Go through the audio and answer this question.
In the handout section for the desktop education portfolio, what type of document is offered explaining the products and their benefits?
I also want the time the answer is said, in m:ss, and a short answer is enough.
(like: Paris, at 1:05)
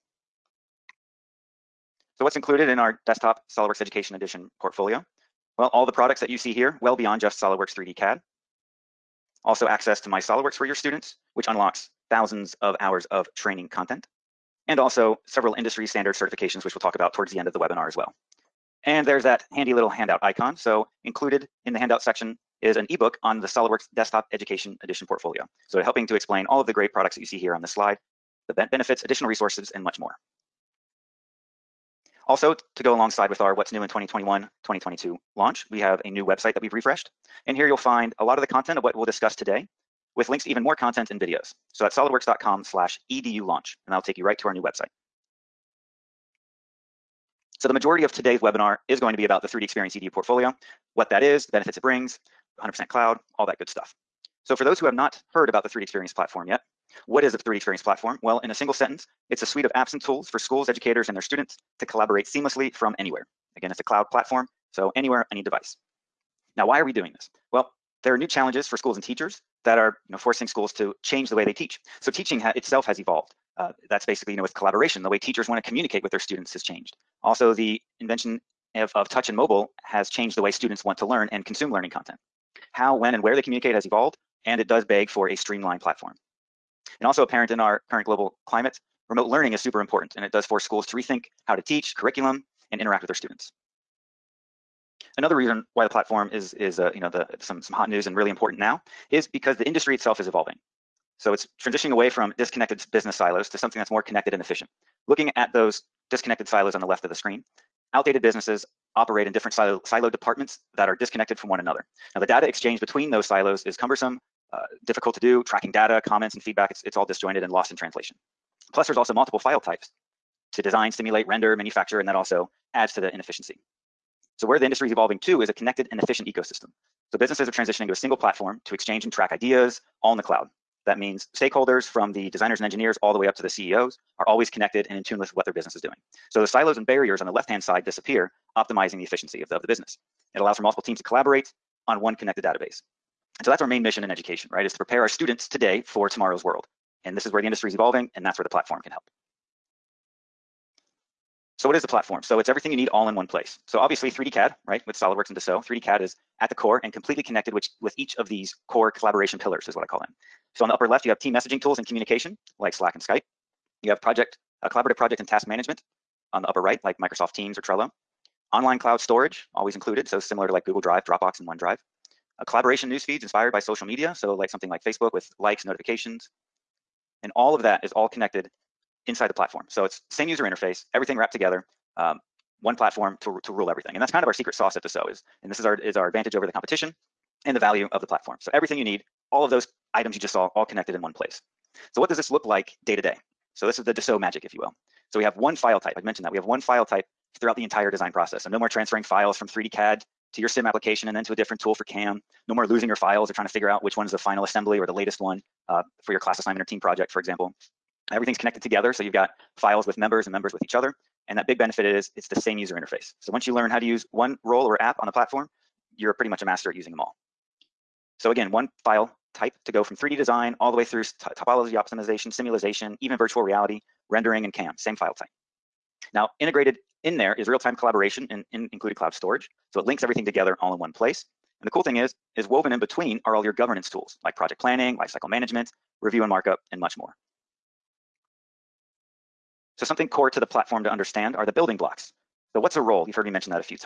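ebook, at 0:22.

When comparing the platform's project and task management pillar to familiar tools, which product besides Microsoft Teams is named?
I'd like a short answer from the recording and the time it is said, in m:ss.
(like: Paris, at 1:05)
Trello, at 2:47.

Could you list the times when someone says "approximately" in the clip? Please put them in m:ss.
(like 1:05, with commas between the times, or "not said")
not said.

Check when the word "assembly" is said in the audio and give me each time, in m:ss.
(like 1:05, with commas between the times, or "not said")
3:24.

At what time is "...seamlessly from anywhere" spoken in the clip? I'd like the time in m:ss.
1:02.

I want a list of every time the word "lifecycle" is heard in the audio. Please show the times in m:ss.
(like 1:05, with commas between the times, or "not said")
3:54.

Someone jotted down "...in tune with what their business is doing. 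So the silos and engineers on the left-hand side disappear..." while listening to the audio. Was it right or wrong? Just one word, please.
wrong.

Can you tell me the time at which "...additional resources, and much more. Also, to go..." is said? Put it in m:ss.
0:29.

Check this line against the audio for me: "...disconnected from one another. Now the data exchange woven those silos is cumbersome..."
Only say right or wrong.
wrong.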